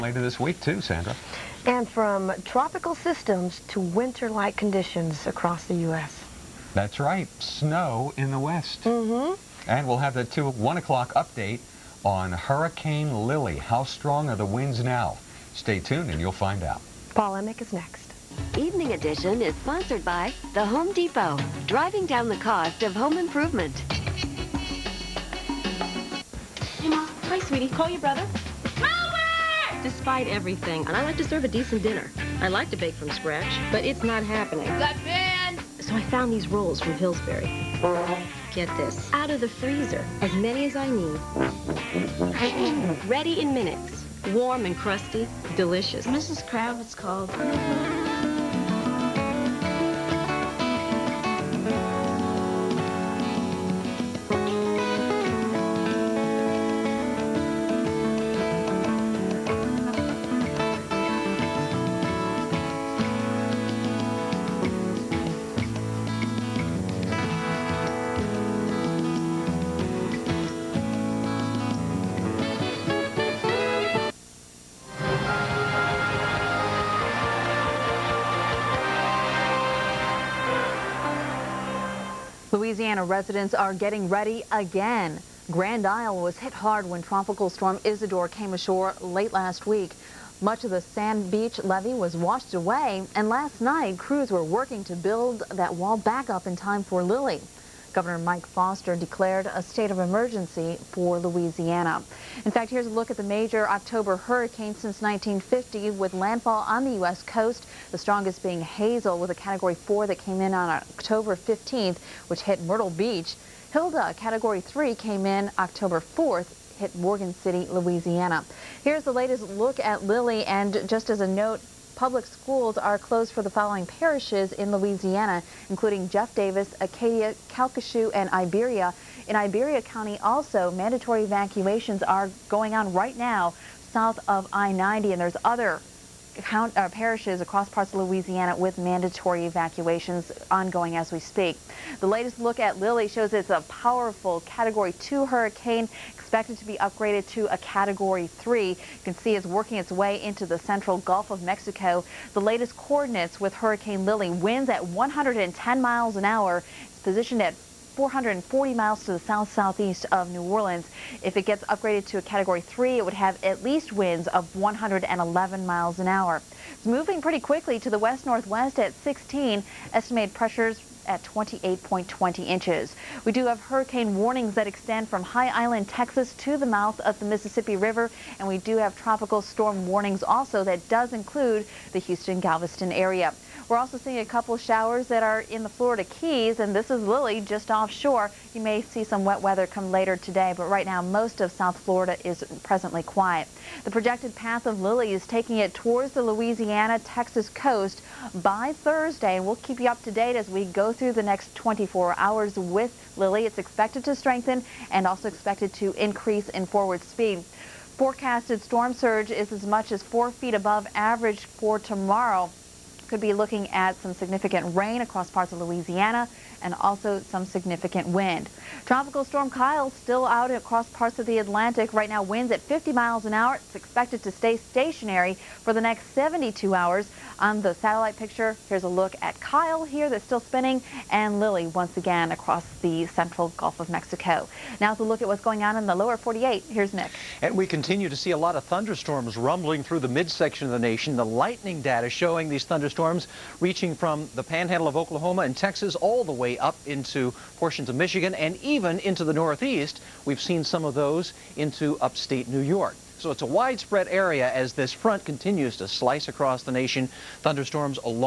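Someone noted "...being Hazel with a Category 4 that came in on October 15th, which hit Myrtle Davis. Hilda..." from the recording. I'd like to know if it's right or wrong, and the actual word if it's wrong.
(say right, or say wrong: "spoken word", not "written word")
wrong: "Beach", not "Davis".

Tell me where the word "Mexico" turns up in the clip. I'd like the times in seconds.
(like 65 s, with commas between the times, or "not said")
151 s, 233 s.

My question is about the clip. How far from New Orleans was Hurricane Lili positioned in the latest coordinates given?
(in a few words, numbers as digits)
440 miles.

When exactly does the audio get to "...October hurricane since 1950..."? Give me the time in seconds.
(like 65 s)
103 s.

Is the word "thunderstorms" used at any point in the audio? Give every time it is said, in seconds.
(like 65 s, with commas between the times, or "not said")
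238 s, 242 s, 257 s.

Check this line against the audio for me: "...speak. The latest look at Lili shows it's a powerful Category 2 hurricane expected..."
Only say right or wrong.
right.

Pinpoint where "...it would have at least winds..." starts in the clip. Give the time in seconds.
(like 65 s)
162 s.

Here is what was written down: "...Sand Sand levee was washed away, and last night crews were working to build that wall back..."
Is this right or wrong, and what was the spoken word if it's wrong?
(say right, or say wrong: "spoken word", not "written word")
wrong: "Beach", not "Sand".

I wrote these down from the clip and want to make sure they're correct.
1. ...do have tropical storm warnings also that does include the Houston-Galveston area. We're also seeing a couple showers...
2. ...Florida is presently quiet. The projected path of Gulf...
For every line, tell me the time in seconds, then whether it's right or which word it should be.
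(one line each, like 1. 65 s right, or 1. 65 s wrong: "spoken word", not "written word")
1. 178 s right
2. 191 s wrong: "Lili", not "Gulf".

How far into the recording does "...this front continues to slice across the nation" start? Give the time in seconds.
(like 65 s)
254 s.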